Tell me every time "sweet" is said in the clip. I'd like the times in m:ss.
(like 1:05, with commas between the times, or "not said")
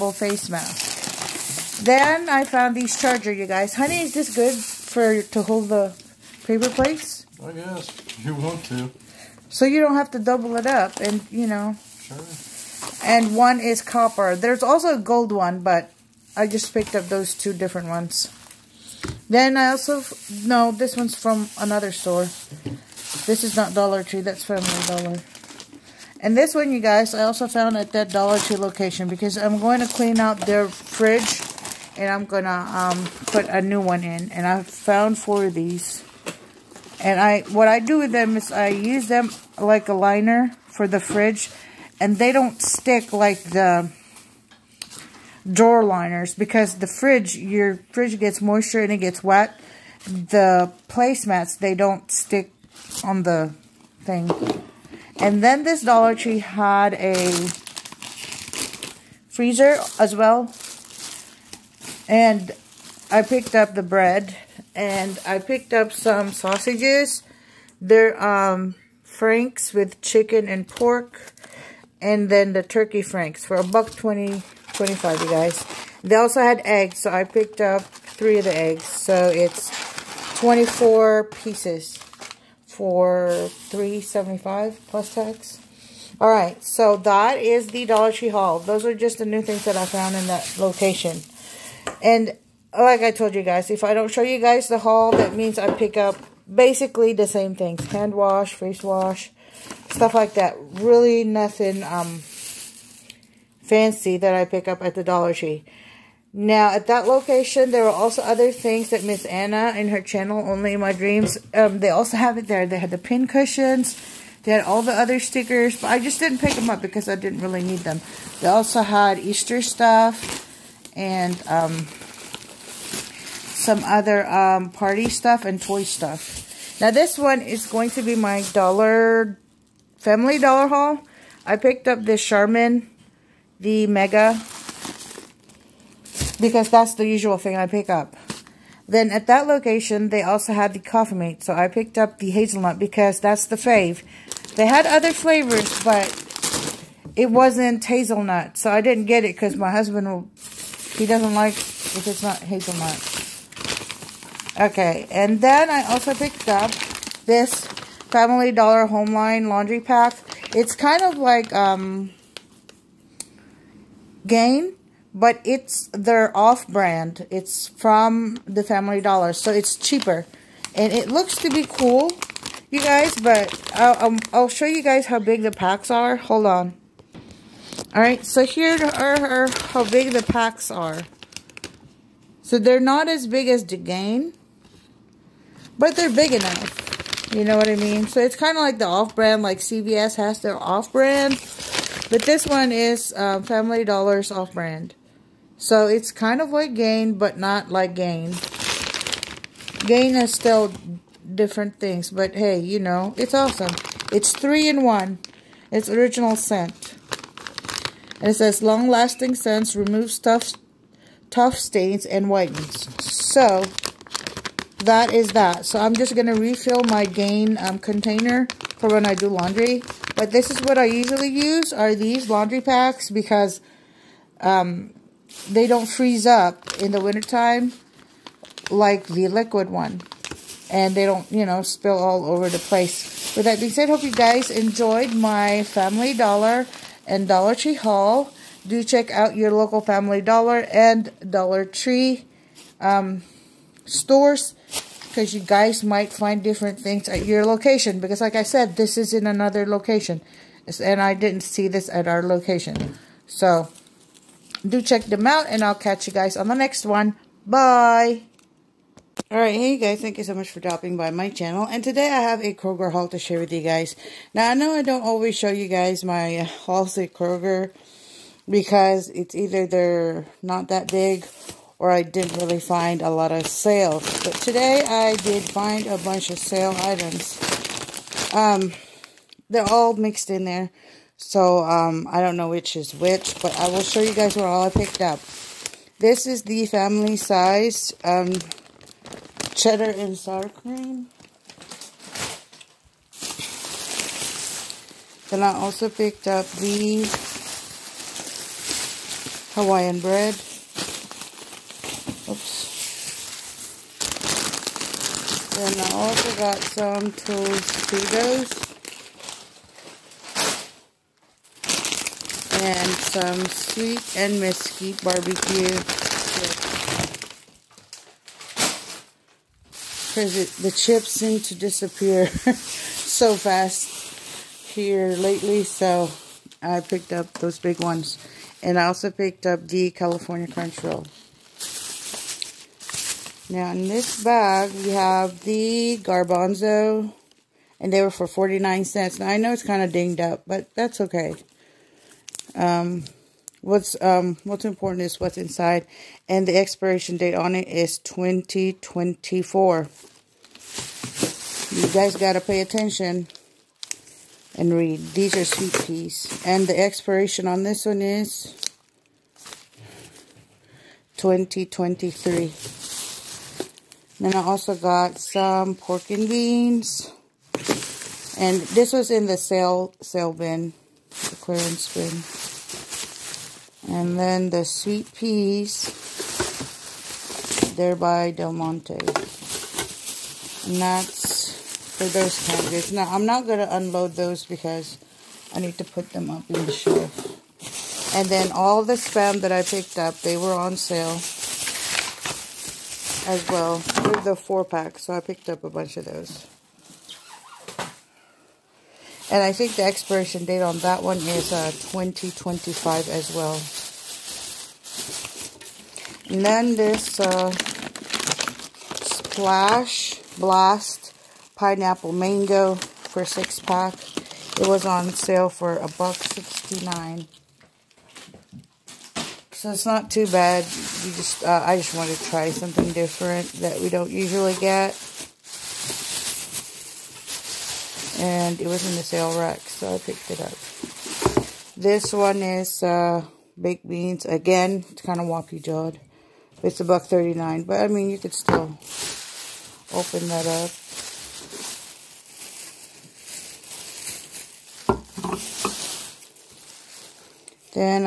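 5:13, 5:55, 6:14.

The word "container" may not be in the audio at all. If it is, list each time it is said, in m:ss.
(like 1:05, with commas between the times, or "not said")
3:37.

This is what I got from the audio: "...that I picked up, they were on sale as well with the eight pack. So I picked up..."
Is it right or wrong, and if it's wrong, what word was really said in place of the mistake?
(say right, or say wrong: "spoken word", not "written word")
wrong: "four", not "eight".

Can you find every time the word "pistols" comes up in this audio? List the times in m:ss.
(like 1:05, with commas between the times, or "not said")
not said.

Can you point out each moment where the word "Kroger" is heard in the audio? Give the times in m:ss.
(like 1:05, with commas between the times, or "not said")
4:22, 4:27.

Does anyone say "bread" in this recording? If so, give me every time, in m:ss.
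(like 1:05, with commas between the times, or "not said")
1:03, 4:59.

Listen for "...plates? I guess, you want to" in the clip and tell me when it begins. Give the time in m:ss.
0:06.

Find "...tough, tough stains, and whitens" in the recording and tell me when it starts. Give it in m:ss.
3:30.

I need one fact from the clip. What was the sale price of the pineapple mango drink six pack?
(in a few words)
$1.69.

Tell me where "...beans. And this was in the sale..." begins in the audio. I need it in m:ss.
6:06.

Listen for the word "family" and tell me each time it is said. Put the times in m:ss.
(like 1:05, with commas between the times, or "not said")
0:24, 2:09, 2:38, 2:48, 3:13, 3:55, 3:59, 4:46.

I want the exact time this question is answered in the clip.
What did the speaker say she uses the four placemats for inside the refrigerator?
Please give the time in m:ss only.
0:39.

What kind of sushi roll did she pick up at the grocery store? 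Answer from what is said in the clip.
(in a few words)
California Crunch Roll.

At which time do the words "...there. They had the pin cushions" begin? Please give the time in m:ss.
1:52.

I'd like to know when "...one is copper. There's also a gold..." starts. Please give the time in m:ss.
0:13.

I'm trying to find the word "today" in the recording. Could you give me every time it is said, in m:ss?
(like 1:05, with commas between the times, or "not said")
4:21, 4:34.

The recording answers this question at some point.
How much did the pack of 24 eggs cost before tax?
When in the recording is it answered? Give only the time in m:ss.
1:23.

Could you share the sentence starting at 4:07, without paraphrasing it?
Because like I said, this is in another location.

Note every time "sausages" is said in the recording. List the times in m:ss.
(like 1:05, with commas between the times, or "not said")
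1:06.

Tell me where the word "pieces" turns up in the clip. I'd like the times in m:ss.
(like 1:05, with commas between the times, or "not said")
1:21.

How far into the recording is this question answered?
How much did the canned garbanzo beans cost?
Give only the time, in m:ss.
5:38.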